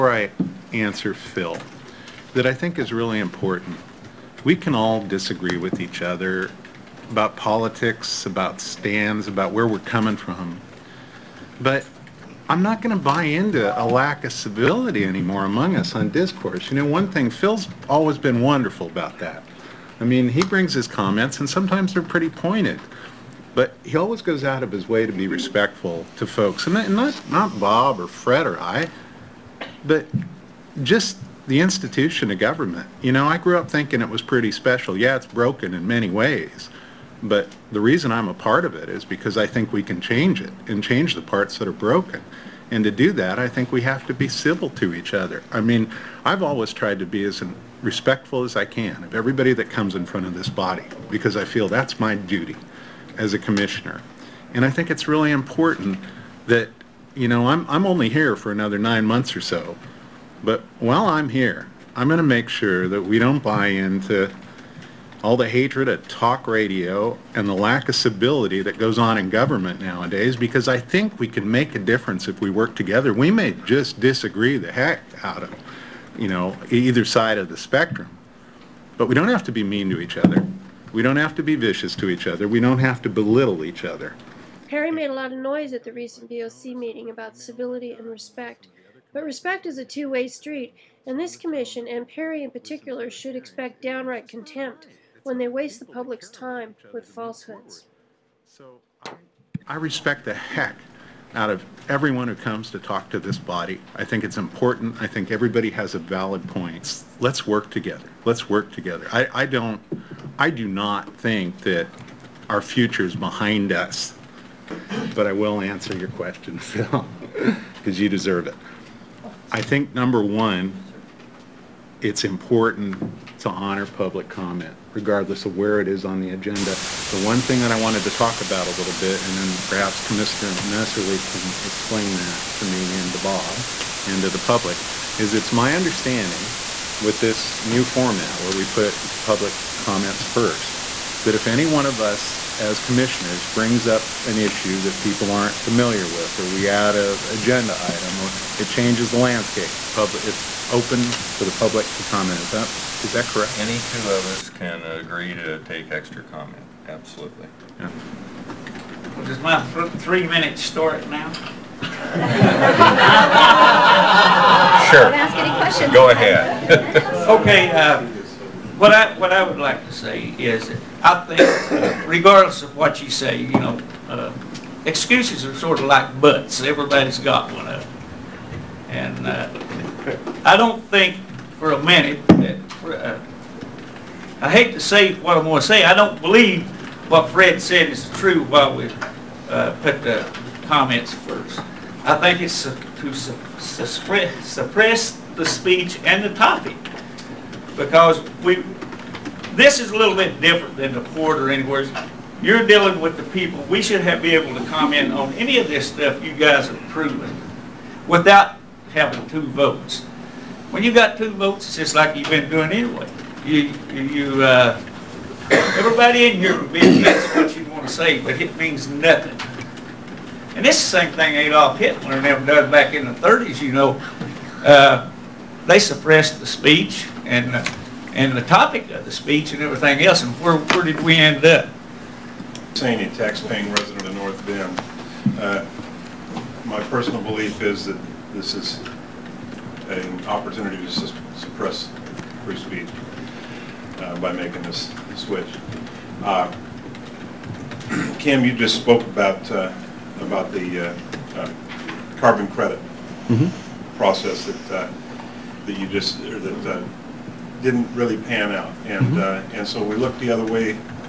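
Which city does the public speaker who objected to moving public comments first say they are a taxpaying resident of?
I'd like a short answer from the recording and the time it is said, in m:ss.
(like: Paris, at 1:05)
North Bend, at 3:54.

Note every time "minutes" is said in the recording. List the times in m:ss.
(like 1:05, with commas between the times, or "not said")
2:40, 3:01.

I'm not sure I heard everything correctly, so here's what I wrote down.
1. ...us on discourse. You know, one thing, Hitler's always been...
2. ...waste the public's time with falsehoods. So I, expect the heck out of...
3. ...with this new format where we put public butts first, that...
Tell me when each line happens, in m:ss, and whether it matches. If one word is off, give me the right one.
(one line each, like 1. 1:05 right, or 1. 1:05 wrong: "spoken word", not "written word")
1. 0:15 wrong: "Phil", not "Hitler"
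2. 1:35 wrong: "respect", not "expect"
3. 2:17 wrong: "comments", not "butts".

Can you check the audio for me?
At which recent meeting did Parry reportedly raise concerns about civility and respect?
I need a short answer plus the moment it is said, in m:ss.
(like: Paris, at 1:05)
BOC meeting, at 1:26.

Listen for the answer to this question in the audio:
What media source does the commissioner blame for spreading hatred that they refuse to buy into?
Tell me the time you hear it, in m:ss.
1:06.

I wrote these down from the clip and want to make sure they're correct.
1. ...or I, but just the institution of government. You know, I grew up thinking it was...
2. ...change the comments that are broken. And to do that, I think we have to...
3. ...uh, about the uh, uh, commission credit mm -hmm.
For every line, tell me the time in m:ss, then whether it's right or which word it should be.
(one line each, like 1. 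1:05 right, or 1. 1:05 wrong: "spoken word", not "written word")
1. 0:28 right
2. 0:40 wrong: "parts", not "comments"
3. 4:09 wrong: "carbon", not "commission".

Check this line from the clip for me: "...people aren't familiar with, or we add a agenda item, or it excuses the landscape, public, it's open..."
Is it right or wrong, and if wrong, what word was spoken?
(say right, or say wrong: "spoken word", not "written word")
wrong: "changes", not "excuses".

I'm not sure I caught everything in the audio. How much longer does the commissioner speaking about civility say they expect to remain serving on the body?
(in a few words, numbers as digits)
nine months.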